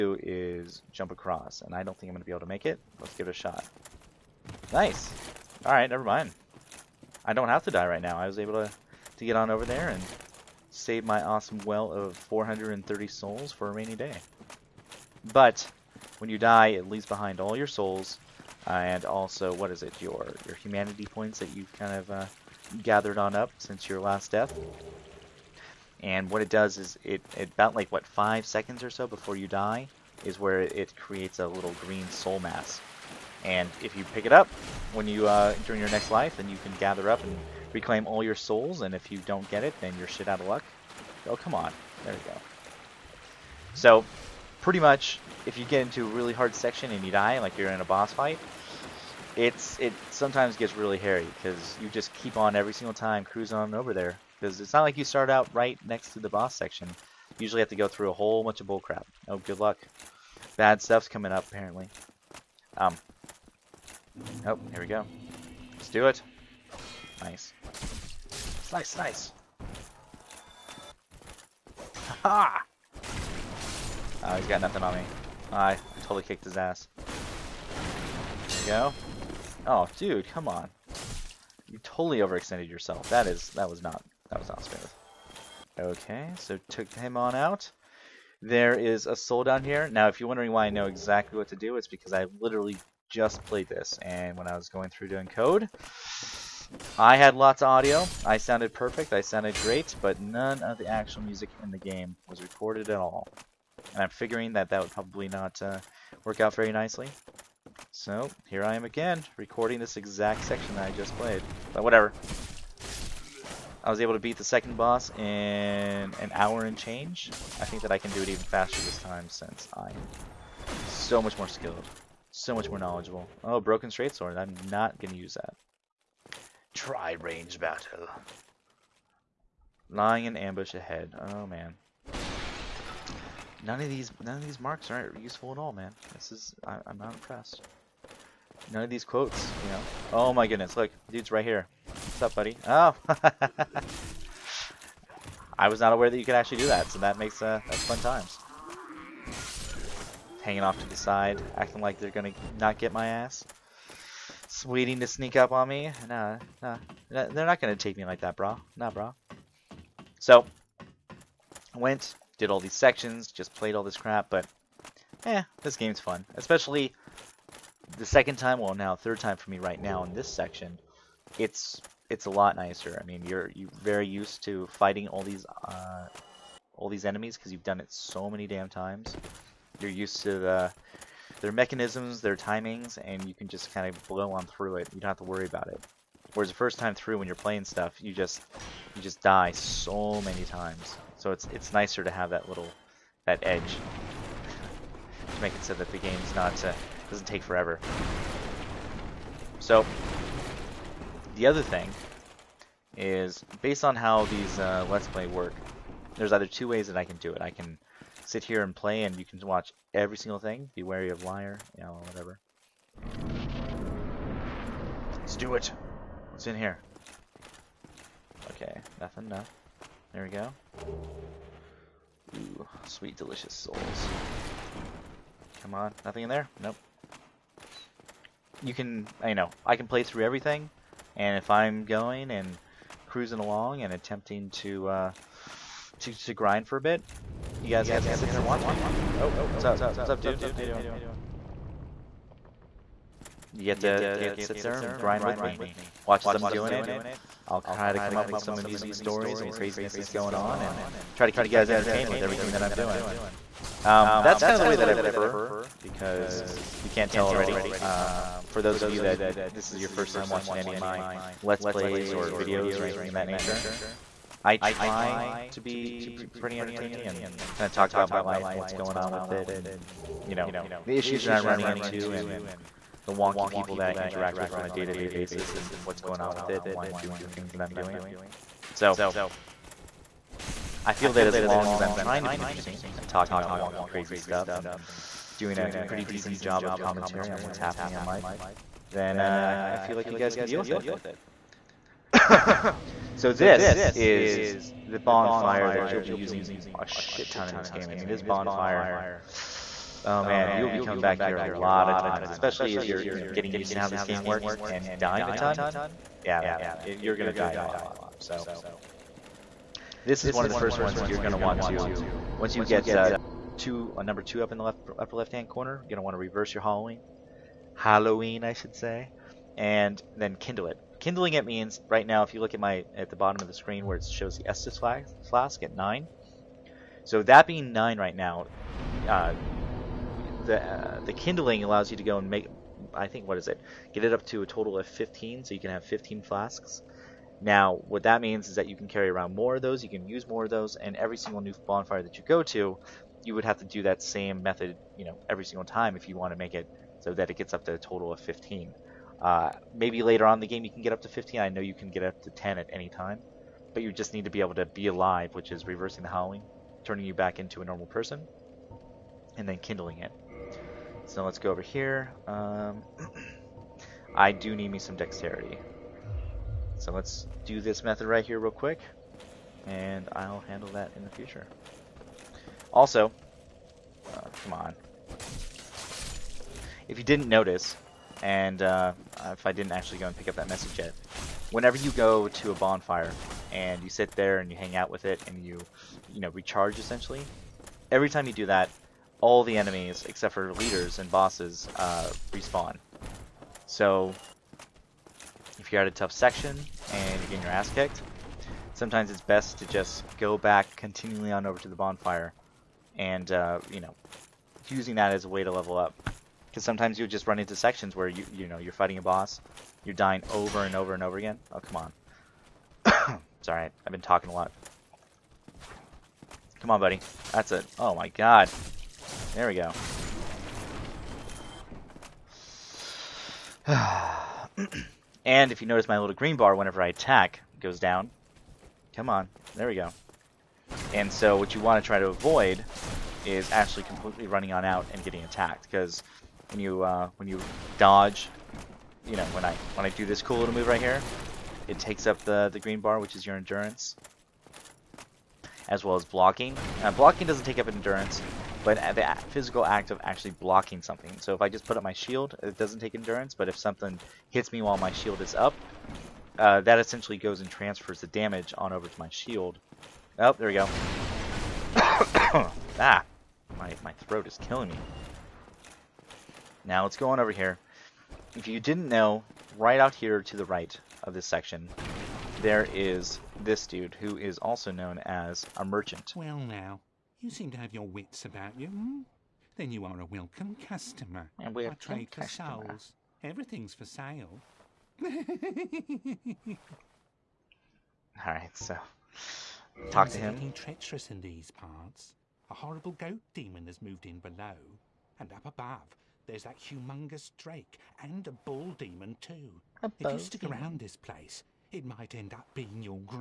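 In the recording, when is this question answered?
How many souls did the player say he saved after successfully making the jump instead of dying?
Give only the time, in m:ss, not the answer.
0:12.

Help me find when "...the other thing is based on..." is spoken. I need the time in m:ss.
3:21.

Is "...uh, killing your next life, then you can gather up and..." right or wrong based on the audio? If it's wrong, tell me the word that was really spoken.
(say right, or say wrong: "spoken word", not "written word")
wrong: "during", not "killing".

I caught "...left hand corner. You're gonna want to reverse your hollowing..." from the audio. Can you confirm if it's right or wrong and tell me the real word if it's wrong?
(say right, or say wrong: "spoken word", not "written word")
right.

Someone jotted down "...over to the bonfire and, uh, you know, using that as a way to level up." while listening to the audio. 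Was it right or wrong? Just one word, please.
right.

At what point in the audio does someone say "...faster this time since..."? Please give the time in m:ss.
1:58.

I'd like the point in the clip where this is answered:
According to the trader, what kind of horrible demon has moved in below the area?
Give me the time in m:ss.
8:12.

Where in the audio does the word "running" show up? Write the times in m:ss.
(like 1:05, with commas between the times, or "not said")
4:31, 7:14.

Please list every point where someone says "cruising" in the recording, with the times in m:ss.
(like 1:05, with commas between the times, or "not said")
0:53, 3:53.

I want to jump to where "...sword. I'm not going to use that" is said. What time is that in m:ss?
2:04.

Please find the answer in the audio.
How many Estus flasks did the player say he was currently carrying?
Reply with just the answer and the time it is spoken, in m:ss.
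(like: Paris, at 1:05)
9, at 5:25.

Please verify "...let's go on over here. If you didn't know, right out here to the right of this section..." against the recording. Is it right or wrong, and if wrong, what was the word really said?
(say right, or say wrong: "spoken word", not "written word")
right.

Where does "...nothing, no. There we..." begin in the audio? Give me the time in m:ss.
3:38.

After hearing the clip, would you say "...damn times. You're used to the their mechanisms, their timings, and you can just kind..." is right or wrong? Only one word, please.
right.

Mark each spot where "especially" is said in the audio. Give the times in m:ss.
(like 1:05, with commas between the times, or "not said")
2:46, 5:02.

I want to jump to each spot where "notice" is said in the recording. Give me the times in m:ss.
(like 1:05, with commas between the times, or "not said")
6:17, 7:05.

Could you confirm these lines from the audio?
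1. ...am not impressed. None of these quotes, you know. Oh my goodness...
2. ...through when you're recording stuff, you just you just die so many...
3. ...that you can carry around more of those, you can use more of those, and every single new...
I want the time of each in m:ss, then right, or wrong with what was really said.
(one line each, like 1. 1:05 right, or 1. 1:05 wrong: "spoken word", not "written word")
1. 2:16 right
2. 3:06 wrong: "playing", not "recording"
3. 5:38 right.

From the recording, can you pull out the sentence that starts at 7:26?
Uh, blocking doesn't take up endurance, but the physical act of actually blocking something.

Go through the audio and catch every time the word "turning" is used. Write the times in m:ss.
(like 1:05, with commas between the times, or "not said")
5:56.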